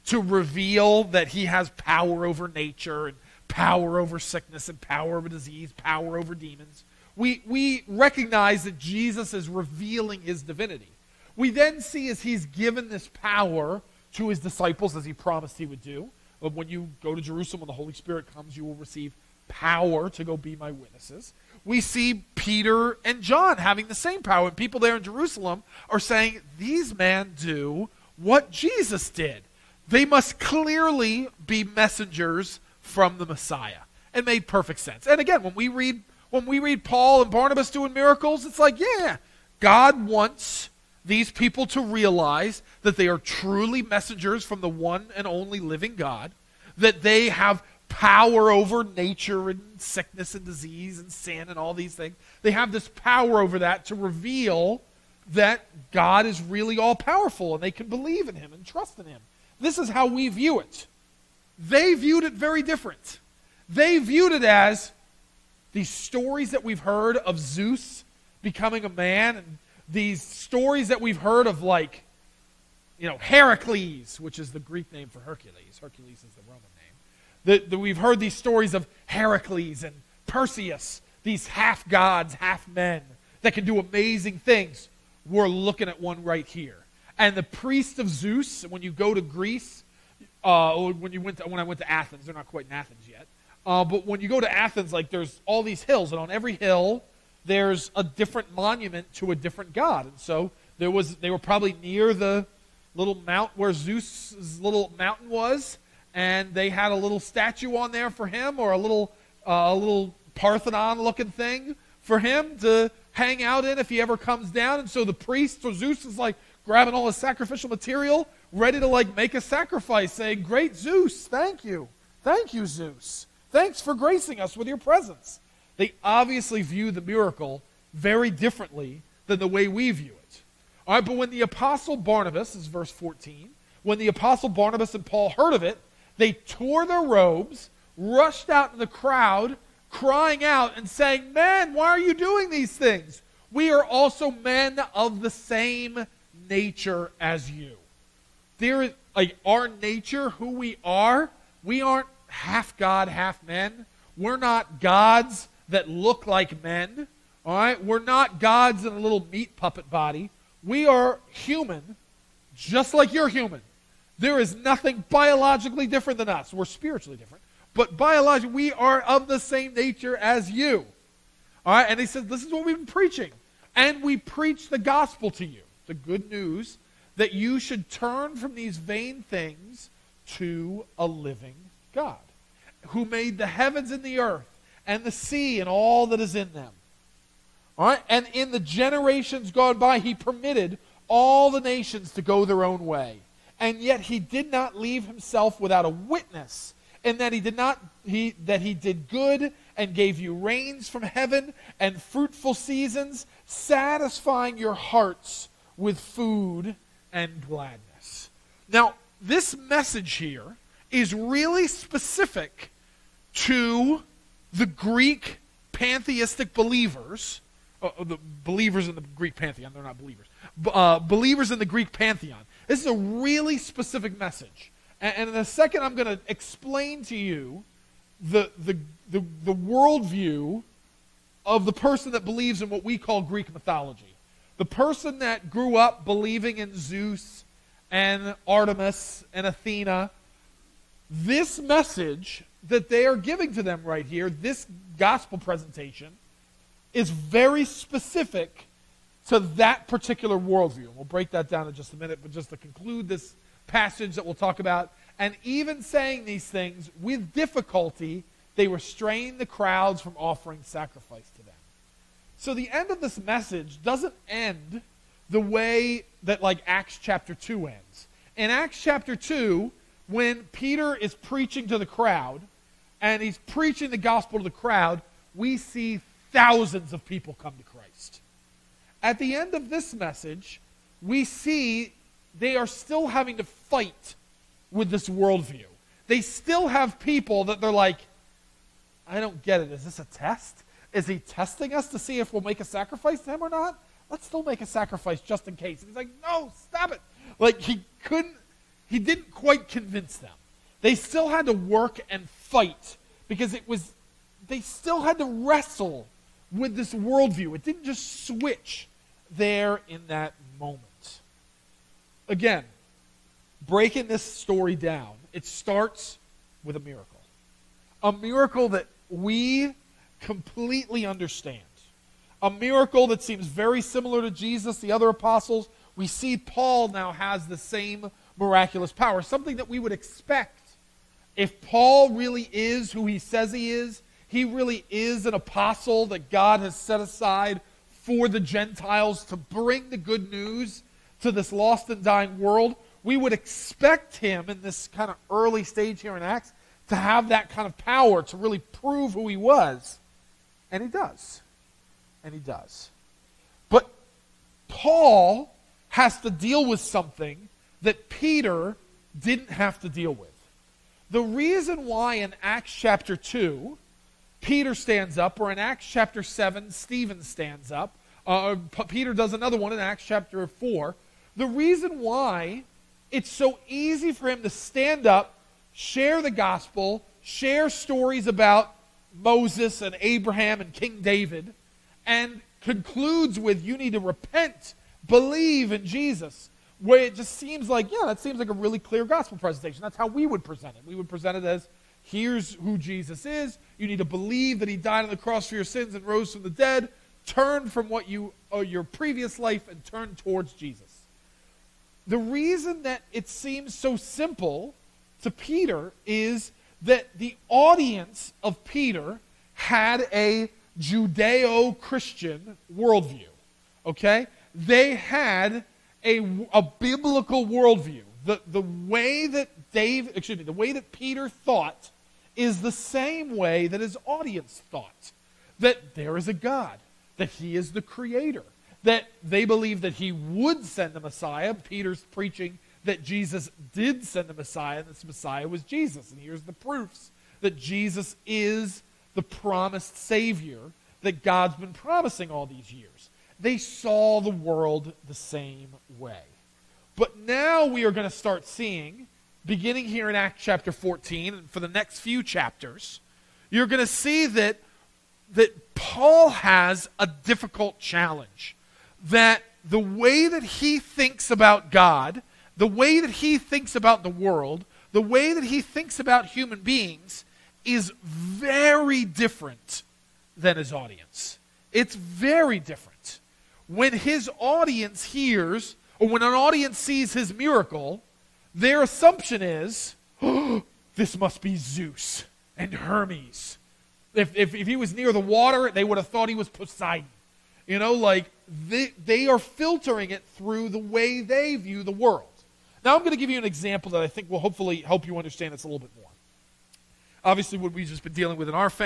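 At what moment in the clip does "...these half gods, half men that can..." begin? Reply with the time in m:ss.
1:21.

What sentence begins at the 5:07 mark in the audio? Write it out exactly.
It didn't just switch there in that moment.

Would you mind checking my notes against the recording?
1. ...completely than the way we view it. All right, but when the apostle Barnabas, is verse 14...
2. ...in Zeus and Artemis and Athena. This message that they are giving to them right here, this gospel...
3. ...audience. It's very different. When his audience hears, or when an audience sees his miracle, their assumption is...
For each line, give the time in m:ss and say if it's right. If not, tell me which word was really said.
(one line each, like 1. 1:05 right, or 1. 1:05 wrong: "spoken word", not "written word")
1. 2:08 wrong: "differently", not "completely"
2. 3:56 right
3. 7:50 right.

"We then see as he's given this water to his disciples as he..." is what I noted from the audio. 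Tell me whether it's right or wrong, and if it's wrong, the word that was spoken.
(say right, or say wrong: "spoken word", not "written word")
wrong: "power", not "water".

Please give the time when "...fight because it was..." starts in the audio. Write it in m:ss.
5:02.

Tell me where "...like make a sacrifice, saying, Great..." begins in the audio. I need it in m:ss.
1:58.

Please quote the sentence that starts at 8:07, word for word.
You know, like they, they are filtering it through the way they view the world.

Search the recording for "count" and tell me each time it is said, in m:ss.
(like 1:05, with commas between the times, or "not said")
not said.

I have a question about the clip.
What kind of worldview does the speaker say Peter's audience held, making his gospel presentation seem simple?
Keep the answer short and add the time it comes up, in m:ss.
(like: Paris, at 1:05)
Judeo Christian, at 6:50.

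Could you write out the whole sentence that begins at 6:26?
Where it just seems like, yeah, that seems like a really clear gospel presentation.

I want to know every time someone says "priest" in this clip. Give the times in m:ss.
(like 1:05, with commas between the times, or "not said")
1:27, 1:55.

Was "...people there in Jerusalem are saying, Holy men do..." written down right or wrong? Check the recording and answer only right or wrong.
wrong.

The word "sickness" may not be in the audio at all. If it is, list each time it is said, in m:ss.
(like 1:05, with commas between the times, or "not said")
0:04, 0:49.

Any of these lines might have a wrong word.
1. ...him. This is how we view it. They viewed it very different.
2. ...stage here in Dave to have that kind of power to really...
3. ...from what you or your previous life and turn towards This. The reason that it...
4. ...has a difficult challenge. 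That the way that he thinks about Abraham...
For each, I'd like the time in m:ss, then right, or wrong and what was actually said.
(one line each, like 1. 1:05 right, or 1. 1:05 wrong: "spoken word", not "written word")
1. 0:59 right
2. 5:45 wrong: "Acts", not "Dave"
3. 6:37 wrong: "Jesus", not "This"
4. 7:36 wrong: "God", not "Abraham".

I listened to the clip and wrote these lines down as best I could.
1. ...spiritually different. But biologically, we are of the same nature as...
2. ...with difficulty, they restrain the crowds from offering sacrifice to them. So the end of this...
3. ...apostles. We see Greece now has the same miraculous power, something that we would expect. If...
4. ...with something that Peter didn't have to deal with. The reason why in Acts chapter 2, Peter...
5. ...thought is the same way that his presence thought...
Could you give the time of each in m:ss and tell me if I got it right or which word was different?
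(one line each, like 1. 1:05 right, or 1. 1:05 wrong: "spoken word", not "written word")
1. 2:46 right
2. 4:17 right
3. 5:25 wrong: "Paul", not "Greece"
4. 5:56 right
5. 7:01 wrong: "audience", not "presence".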